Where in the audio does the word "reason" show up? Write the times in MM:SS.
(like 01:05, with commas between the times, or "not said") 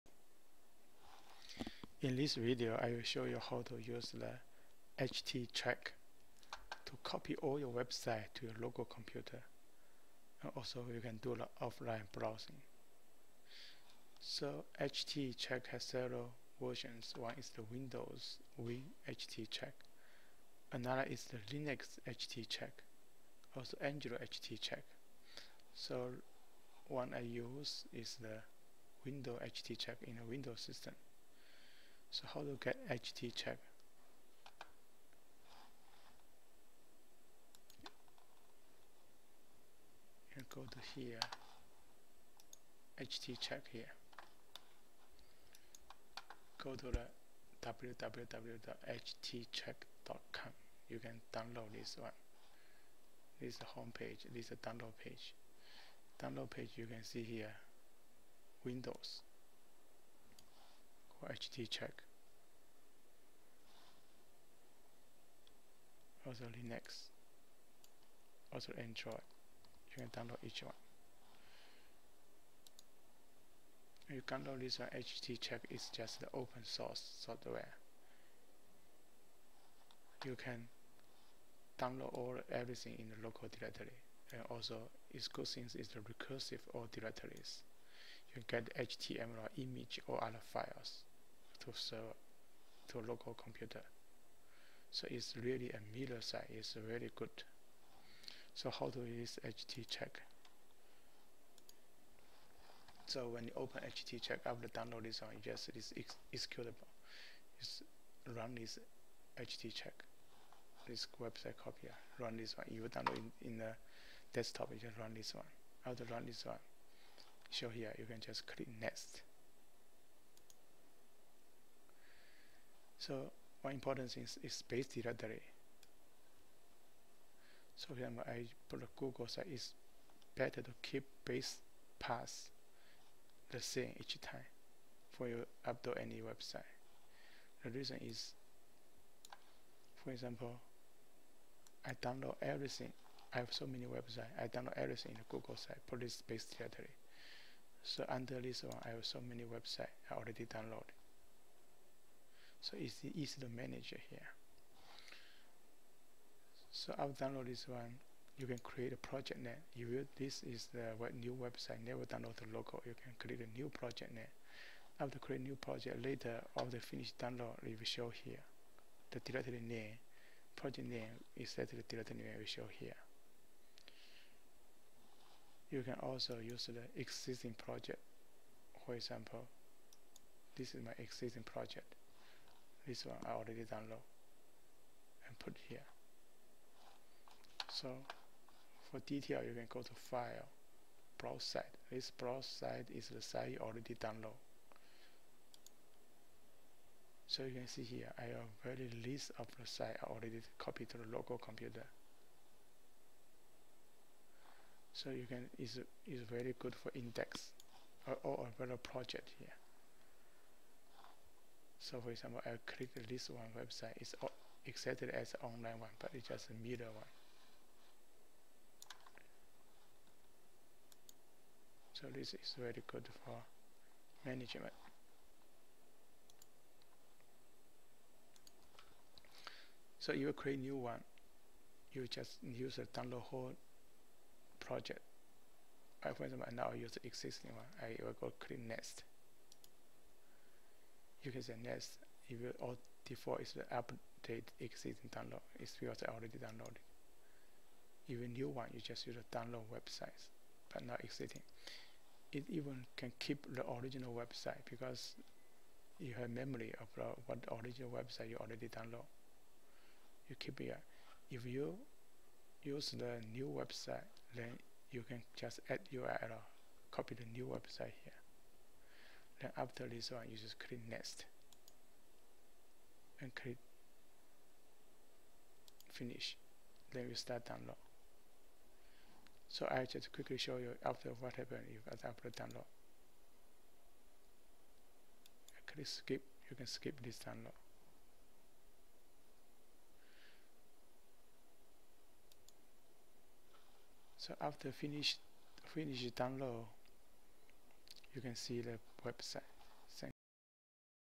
02:17.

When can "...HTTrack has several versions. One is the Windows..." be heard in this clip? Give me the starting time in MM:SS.
00:14.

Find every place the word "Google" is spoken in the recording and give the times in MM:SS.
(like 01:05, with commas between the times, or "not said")
02:08, 02:25.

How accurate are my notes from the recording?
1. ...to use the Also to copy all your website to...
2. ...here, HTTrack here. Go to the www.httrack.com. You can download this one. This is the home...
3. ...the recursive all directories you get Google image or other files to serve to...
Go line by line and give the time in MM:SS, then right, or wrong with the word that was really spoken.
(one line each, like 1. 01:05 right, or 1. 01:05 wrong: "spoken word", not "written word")
1. 00:03 wrong: "HTTrack", not "Also"
2. 00:40 right
3. 01:25 wrong: "HTML", not "Google".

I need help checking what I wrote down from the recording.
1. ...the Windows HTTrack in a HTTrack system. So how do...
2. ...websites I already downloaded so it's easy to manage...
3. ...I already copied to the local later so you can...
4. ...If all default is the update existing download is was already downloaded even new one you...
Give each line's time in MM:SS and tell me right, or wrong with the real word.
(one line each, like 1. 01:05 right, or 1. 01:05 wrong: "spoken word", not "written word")
1. 00:28 wrong: "Windows", not "HTTrack"
2. 02:29 right
3. 03:20 wrong: "computer", not "later"
4. 04:02 right.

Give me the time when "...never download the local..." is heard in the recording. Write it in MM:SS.
02:41.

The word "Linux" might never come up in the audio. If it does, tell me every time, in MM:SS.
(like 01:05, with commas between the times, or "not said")
00:21, 01:06.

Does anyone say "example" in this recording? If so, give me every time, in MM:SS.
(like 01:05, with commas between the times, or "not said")
02:07, 02:20, 02:58, 03:32, 03:56.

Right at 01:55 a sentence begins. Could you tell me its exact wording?
After run this one, show here, you can just click next.